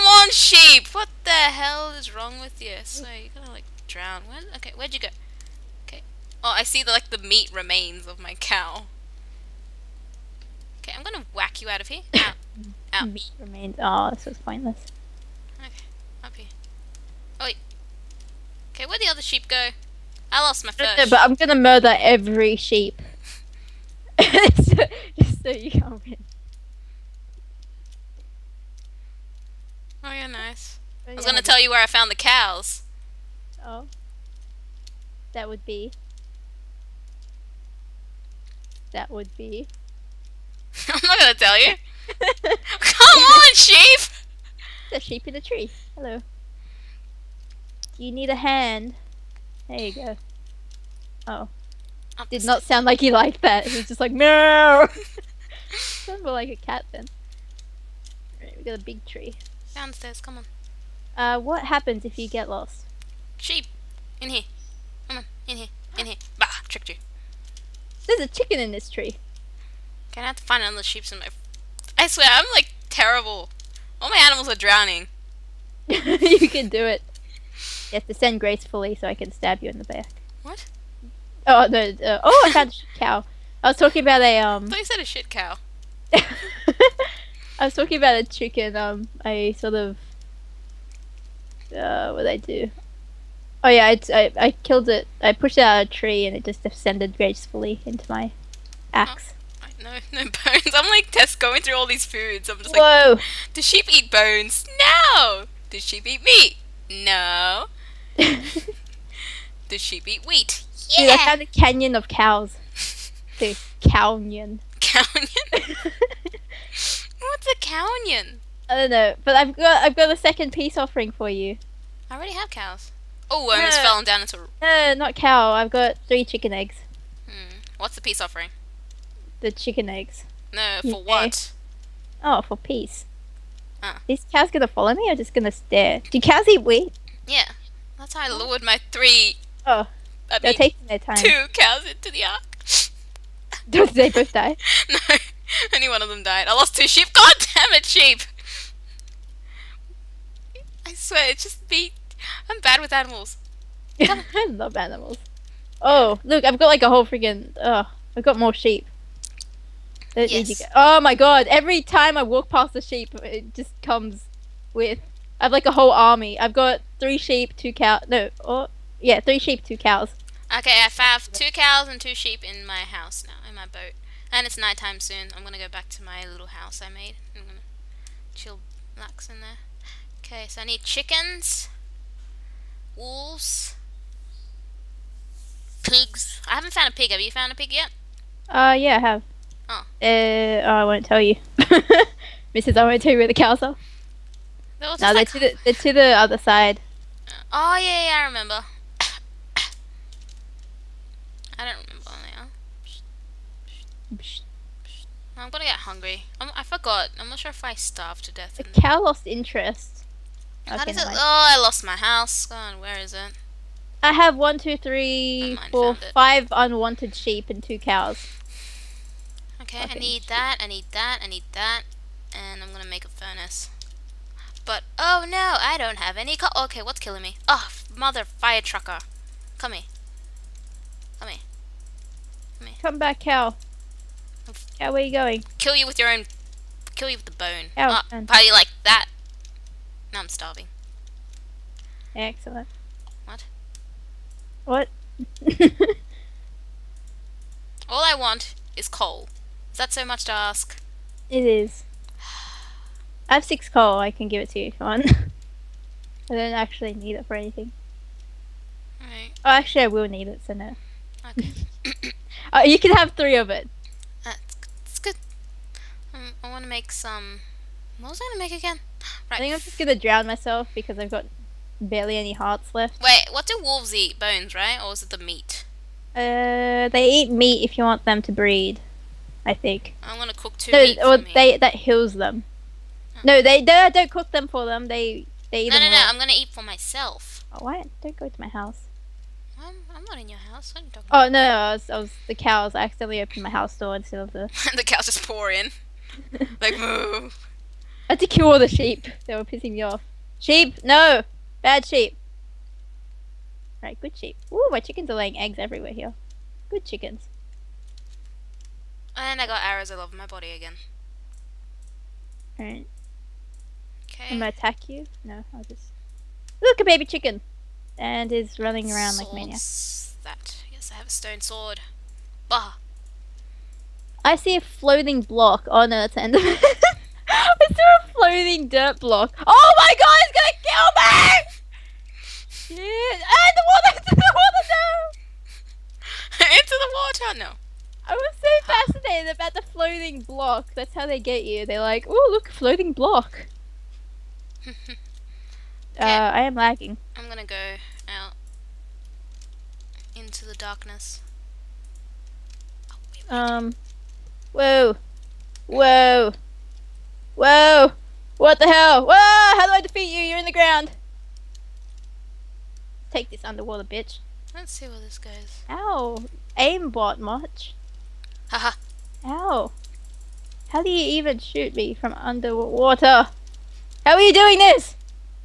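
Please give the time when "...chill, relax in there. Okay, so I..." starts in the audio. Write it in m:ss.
2:58.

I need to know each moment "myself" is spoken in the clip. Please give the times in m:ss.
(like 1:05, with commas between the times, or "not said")
4:30, 4:46.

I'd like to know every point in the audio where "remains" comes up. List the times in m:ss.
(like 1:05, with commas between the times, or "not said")
0:07, 0:13.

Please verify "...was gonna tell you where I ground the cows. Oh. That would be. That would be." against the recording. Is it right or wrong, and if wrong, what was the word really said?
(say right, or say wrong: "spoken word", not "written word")
wrong: "found", not "ground".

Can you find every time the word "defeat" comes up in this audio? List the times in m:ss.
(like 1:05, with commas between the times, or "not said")
5:59.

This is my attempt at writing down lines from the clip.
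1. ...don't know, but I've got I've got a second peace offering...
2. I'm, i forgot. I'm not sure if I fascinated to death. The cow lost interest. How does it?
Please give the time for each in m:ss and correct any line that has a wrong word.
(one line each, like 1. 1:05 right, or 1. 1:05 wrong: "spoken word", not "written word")
1. 1:58 right
2. 3:26 wrong: "starved", not "fascinated".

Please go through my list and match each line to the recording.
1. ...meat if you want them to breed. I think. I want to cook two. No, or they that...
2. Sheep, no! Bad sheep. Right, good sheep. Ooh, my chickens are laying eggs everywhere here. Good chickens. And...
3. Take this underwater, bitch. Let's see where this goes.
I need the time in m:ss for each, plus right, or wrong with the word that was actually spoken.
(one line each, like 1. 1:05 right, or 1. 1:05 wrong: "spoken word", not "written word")
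1. 4:37 right
2. 5:00 right
3. 6:03 right.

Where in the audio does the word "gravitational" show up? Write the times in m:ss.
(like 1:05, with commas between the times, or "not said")
not said.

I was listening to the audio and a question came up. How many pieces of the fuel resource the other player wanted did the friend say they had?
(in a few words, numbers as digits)
6.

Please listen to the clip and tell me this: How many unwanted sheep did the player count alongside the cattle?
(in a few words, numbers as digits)
5.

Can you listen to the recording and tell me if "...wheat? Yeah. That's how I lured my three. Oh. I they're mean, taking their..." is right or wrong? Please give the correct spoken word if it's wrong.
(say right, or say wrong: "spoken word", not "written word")
right.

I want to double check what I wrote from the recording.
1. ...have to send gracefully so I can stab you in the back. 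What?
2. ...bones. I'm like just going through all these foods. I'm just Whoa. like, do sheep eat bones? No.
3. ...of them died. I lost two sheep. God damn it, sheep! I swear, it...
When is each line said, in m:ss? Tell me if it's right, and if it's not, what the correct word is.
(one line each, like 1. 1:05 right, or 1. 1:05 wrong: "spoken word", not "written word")
1. 1:17 right
2. 1:40 right
3. 2:26 right.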